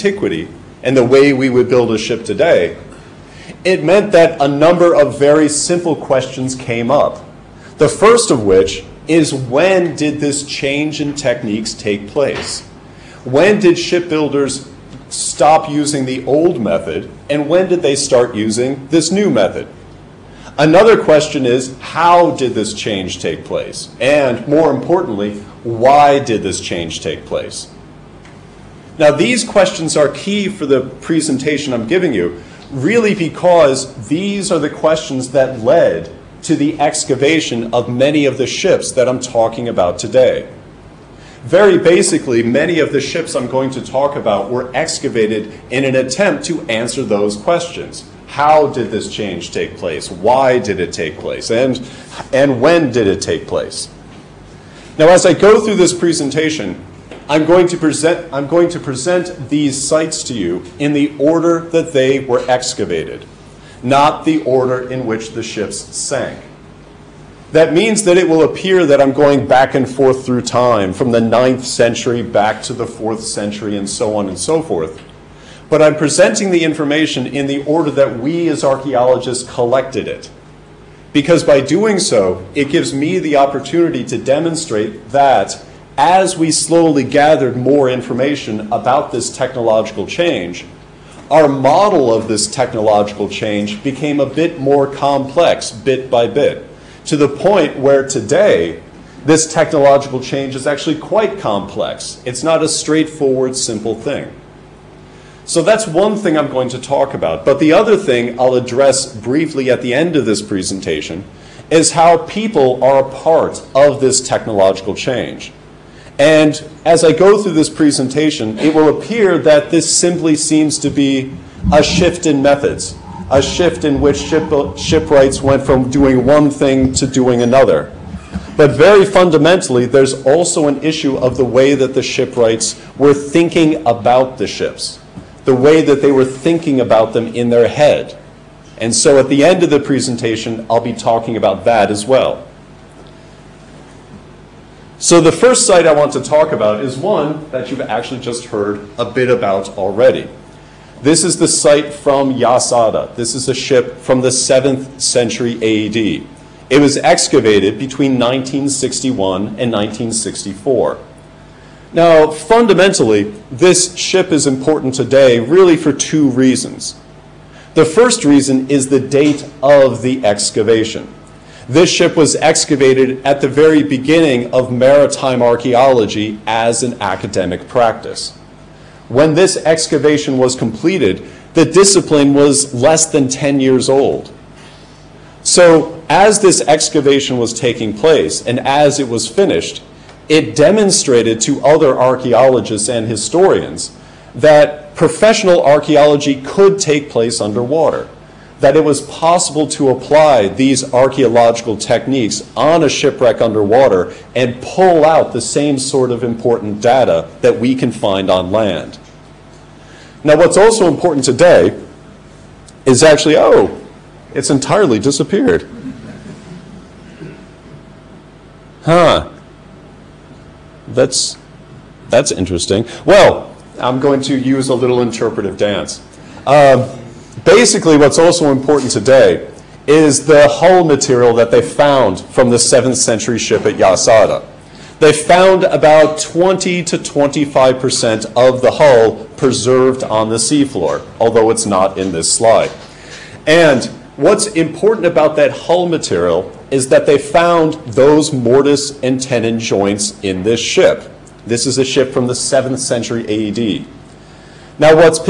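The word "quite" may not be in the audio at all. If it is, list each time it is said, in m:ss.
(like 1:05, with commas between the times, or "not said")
1:40.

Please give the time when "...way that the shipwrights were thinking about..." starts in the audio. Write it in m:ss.
2:11.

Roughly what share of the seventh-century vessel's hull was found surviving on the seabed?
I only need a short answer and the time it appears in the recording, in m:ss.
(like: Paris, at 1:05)
20 to 25%, at 3:56.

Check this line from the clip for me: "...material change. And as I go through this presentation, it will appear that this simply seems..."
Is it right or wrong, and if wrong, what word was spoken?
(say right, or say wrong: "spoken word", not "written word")
wrong: "technological", not "material".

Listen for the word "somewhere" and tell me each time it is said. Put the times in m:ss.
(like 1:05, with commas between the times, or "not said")
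not said.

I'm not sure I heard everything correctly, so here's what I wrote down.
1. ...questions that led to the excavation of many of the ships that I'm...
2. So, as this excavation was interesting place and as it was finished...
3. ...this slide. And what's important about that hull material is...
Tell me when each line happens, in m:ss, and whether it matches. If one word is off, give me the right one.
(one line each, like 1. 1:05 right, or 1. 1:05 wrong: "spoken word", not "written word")
1. 0:34 right
2. 3:05 wrong: "taking", not "interesting"
3. 4:02 right.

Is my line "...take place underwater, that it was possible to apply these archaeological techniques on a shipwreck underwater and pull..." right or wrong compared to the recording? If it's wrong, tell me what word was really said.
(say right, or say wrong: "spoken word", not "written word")
right.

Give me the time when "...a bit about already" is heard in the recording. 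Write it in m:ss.
2:28.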